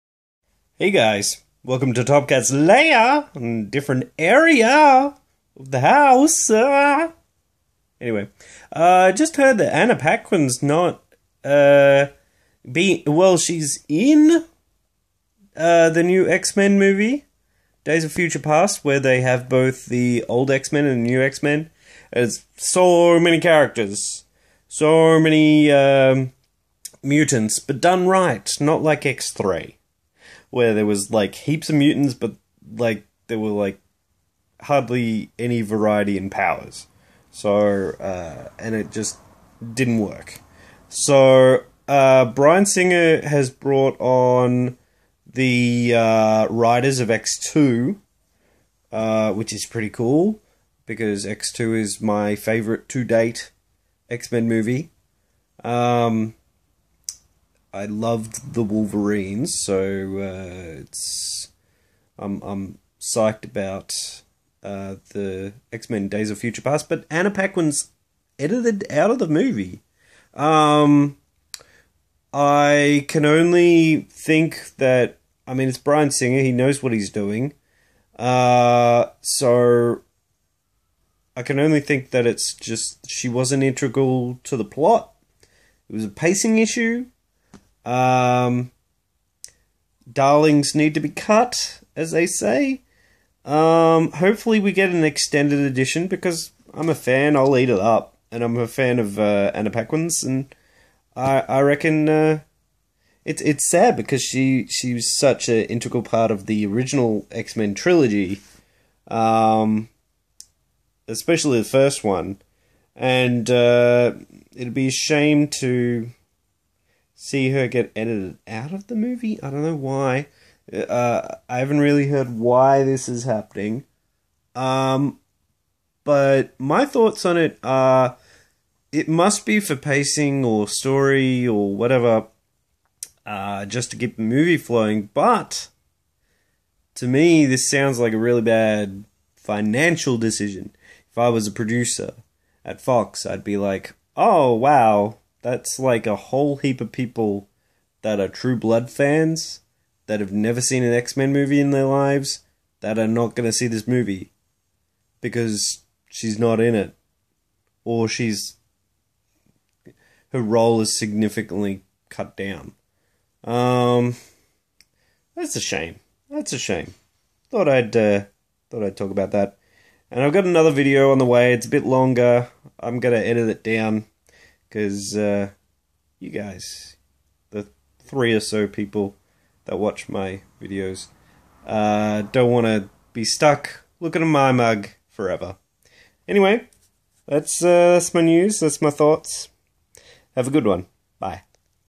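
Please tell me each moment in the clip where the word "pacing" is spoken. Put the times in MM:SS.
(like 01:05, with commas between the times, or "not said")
01:26, 02:09.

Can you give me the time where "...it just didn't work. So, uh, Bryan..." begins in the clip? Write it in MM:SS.
00:38.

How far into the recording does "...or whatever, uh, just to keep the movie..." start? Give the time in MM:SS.
02:11.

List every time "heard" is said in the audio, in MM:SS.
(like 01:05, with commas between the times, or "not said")
00:09, 02:02.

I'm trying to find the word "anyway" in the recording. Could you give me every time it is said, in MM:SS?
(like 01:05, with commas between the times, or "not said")
00:08, 03:06.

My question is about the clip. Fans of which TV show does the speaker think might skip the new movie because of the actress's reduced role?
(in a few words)
True Blood.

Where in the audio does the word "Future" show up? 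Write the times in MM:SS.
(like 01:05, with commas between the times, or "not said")
00:18, 01:06.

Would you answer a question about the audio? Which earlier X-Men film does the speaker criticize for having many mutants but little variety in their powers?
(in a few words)
X3.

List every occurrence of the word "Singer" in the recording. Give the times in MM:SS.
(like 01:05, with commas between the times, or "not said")
00:42, 01:16.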